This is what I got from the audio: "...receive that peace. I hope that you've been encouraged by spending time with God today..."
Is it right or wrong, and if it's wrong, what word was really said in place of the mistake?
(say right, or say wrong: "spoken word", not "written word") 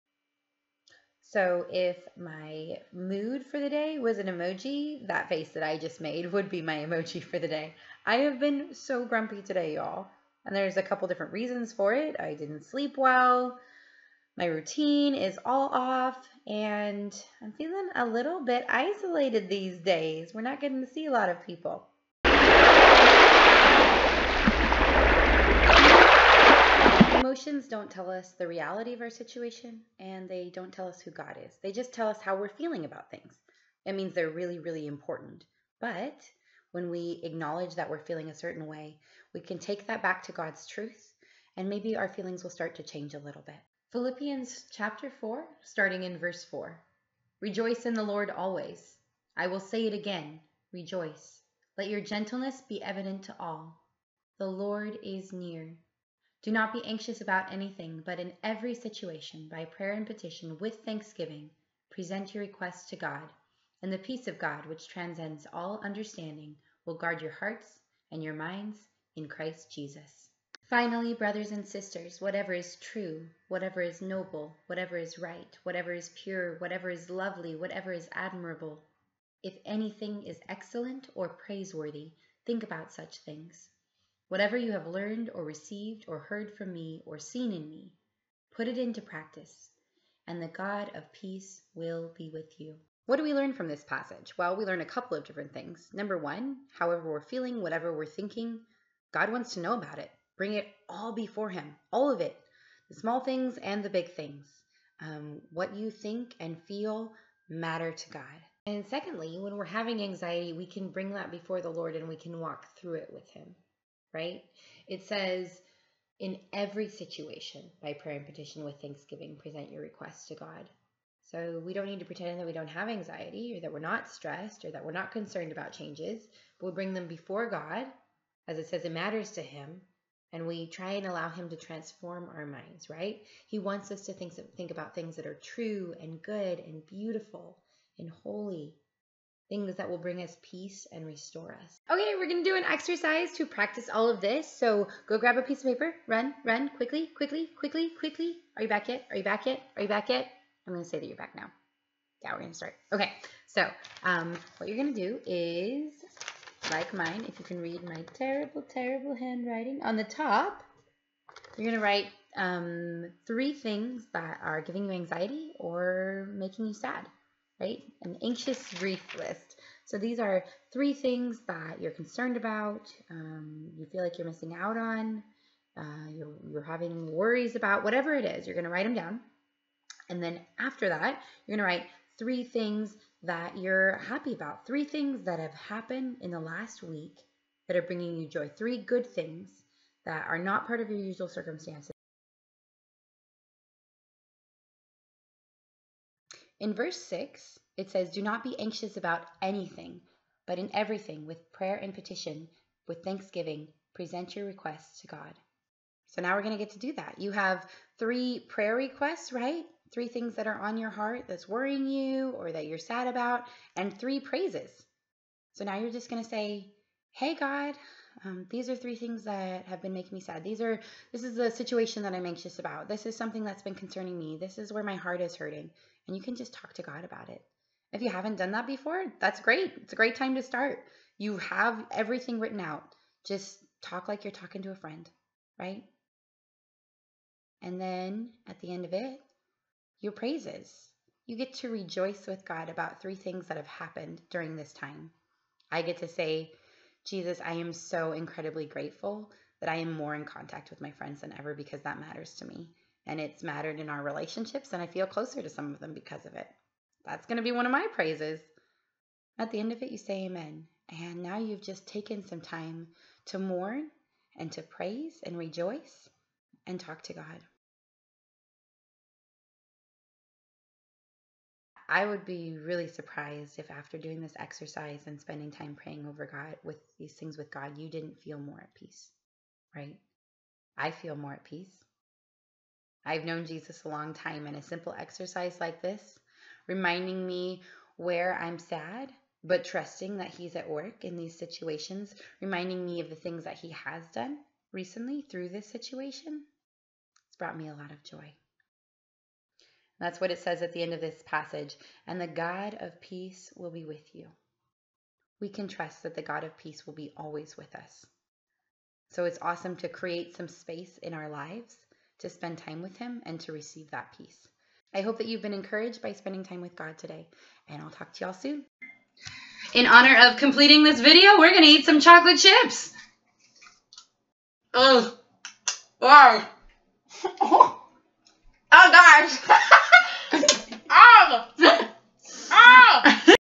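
right.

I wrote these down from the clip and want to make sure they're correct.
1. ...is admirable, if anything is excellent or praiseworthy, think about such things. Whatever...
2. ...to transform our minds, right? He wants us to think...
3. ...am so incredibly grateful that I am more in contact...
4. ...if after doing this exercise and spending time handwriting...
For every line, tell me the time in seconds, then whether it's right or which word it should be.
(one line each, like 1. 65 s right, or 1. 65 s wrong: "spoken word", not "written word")
1. 77 s right
2. 131 s right
3. 247 s right
4. 273 s wrong: "praying", not "handwriting".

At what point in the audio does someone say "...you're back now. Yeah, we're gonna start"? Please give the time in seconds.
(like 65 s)
151 s.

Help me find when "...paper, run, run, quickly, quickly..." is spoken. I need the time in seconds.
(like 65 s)
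145 s.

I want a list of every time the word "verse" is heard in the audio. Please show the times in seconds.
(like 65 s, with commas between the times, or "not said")
46 s, 196 s.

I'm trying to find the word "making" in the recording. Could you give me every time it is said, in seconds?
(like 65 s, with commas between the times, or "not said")
166 s, 219 s.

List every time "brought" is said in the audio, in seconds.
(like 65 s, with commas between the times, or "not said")
297 s.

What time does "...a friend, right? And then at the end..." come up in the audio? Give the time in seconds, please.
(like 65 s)
234 s.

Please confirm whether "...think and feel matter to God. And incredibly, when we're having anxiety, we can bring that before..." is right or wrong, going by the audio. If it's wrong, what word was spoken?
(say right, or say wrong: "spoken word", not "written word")
wrong: "secondly", not "incredibly".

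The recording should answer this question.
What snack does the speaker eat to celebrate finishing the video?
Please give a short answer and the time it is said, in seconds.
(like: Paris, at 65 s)
Chocolate chips, at 321 s.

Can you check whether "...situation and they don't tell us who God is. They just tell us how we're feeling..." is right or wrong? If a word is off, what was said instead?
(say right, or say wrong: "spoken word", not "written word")
right.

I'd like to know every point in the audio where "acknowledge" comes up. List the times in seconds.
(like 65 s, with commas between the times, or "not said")
37 s.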